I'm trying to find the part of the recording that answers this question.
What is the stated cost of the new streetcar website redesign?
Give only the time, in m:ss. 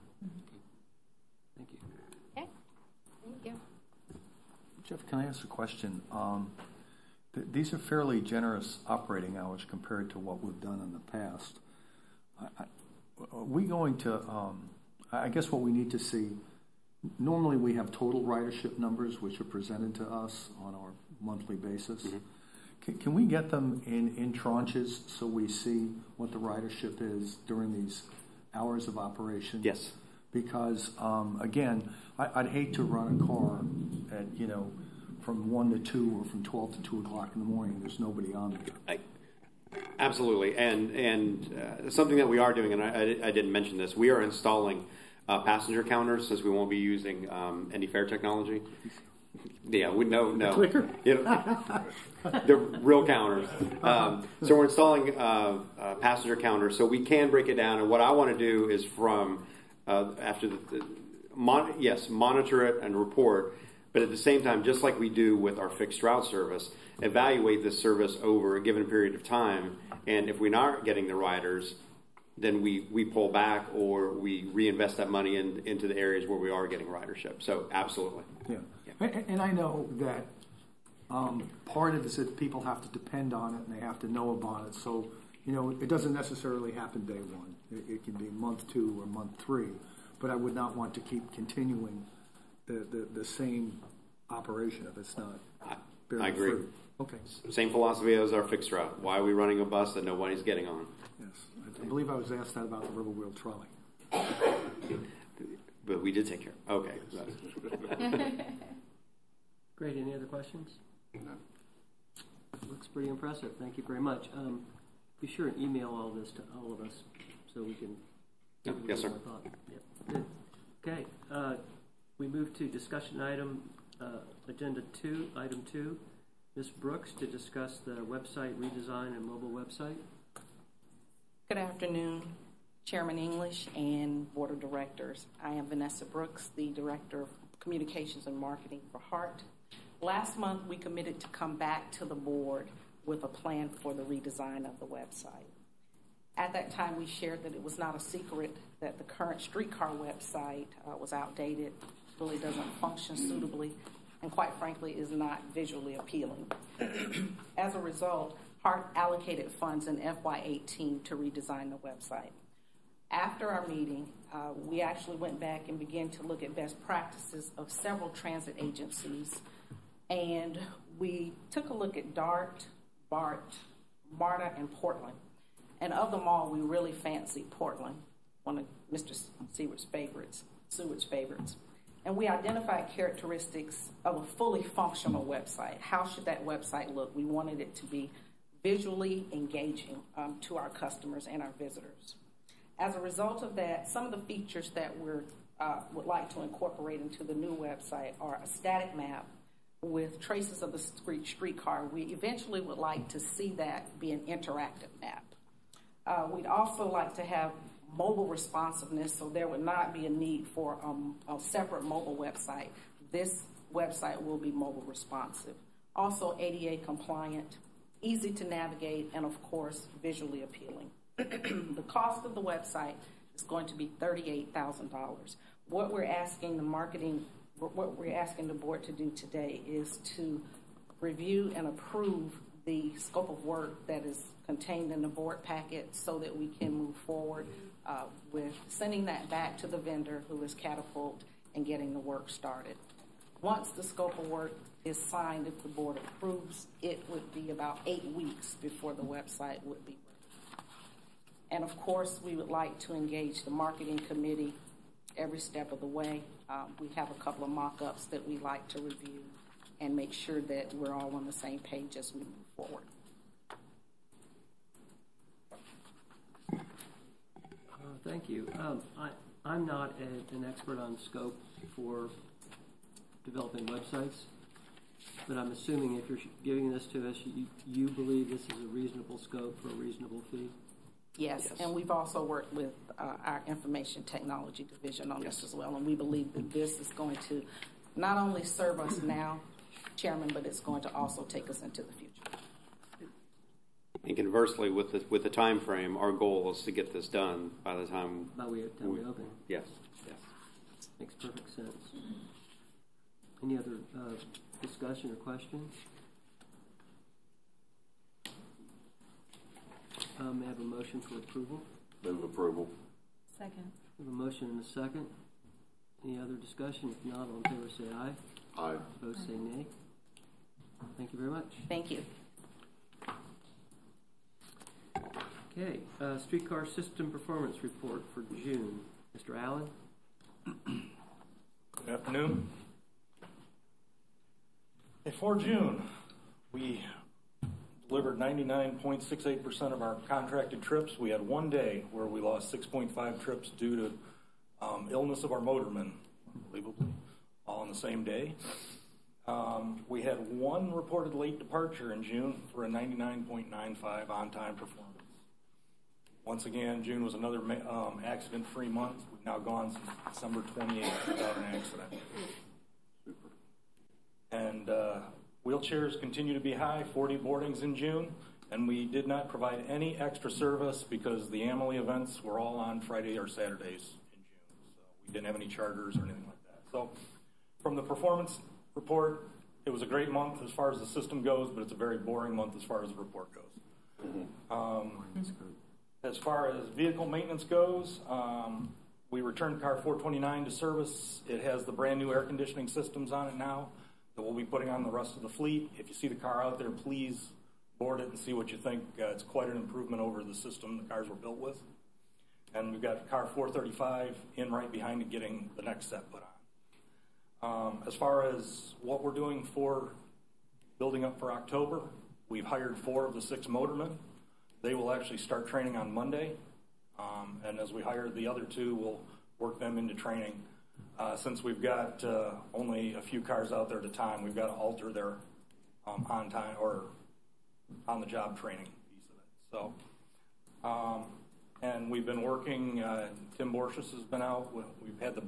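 3:43.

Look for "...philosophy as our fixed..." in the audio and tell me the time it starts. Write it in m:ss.
1:37.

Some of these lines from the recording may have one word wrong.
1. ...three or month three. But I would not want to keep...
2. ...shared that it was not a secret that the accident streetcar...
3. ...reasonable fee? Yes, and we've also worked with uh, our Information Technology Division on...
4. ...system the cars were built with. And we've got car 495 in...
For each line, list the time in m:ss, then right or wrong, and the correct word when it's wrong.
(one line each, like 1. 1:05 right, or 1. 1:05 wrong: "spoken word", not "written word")
1. 1:28 wrong: "two", not "three"
2. 2:27 wrong: "current", not "accident"
3. 4:39 right
4. 6:40 wrong: "435", not "495".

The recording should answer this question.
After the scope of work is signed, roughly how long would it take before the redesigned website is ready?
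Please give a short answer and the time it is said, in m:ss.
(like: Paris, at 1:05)
eight weeks, at 4:07.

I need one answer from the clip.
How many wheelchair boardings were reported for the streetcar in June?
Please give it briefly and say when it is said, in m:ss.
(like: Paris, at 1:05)
40, at 6:06.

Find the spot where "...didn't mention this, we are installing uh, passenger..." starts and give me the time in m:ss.
0:43.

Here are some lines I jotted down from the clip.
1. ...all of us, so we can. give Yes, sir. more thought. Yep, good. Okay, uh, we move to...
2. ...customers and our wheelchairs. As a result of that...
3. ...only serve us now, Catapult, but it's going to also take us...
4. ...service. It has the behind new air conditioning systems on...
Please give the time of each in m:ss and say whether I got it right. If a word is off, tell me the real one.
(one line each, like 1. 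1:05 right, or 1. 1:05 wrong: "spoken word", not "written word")
1. 1:56 right
2. 3:10 wrong: "visitors", not "wheelchairs"
3. 4:48 wrong: "Chairman", not "Catapult"
4. 6:30 wrong: "brand", not "behind".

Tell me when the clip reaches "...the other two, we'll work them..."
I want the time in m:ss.
6:58.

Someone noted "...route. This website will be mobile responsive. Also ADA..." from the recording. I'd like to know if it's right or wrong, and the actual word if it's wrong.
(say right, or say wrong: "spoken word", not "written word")
wrong: "website", not "route".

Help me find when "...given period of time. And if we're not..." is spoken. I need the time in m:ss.
1:08.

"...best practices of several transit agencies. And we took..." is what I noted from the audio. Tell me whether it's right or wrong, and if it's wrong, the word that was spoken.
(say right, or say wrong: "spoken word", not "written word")
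right.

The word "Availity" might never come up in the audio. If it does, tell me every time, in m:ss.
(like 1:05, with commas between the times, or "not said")
not said.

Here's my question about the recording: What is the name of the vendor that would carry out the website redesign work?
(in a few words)
Catapult.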